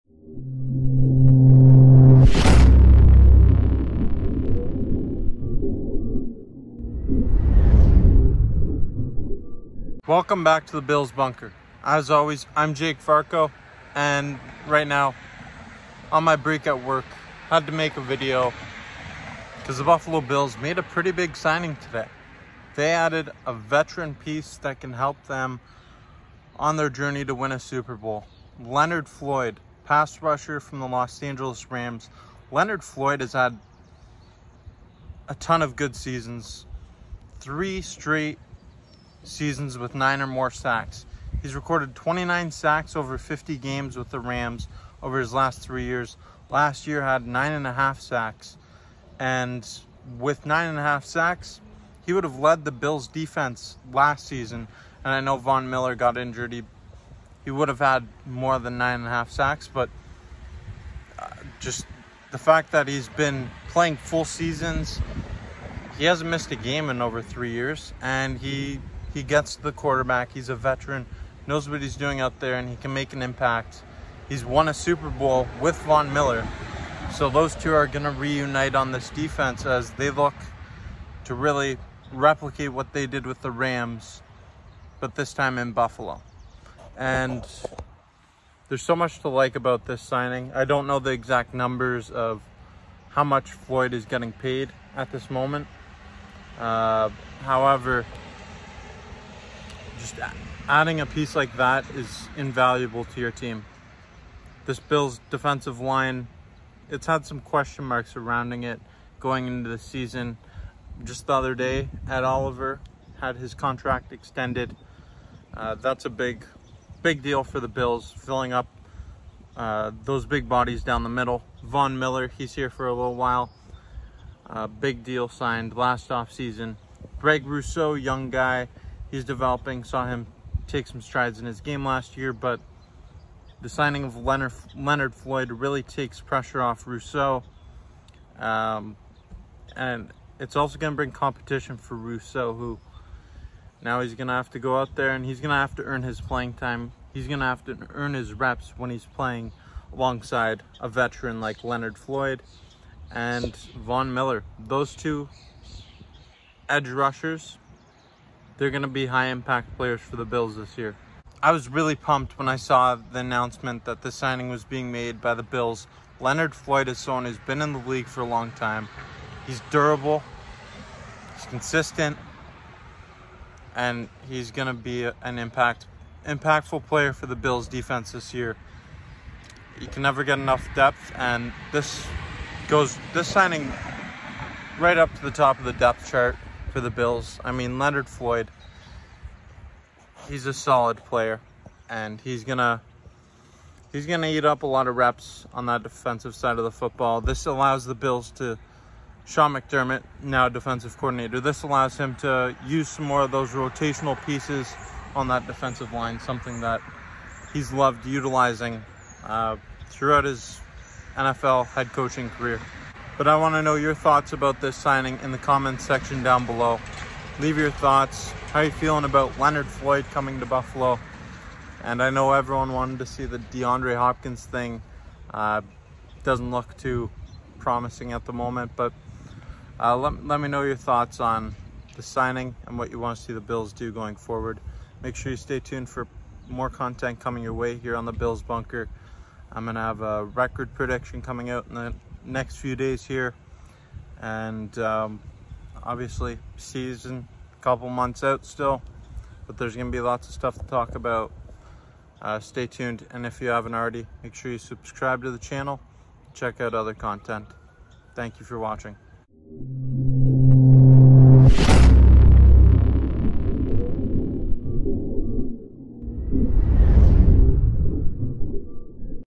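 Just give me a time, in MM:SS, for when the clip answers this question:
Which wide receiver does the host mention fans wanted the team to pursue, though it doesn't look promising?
03:43.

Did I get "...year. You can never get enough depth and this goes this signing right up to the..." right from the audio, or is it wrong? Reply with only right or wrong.
right.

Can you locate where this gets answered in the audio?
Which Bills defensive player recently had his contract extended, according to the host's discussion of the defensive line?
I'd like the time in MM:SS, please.
01:52.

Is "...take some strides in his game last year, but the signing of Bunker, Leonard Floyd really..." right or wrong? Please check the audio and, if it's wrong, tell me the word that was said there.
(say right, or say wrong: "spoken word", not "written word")
wrong: "Leonard", not "Bunker".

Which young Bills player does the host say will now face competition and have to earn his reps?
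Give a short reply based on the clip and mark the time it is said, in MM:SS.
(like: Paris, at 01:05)
Greg Rousseau, at 02:07.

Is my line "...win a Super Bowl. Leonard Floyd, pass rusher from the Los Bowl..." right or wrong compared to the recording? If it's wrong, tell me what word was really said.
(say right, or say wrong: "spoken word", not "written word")
wrong: "Angeles", not "Bowl".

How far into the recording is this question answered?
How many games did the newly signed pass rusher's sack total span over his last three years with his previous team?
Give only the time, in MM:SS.
00:43.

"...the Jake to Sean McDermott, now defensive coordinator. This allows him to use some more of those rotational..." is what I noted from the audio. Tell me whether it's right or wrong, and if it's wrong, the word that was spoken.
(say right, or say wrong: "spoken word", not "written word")
wrong: "Bills", not "Jake".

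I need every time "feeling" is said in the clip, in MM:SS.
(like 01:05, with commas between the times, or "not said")
03:38.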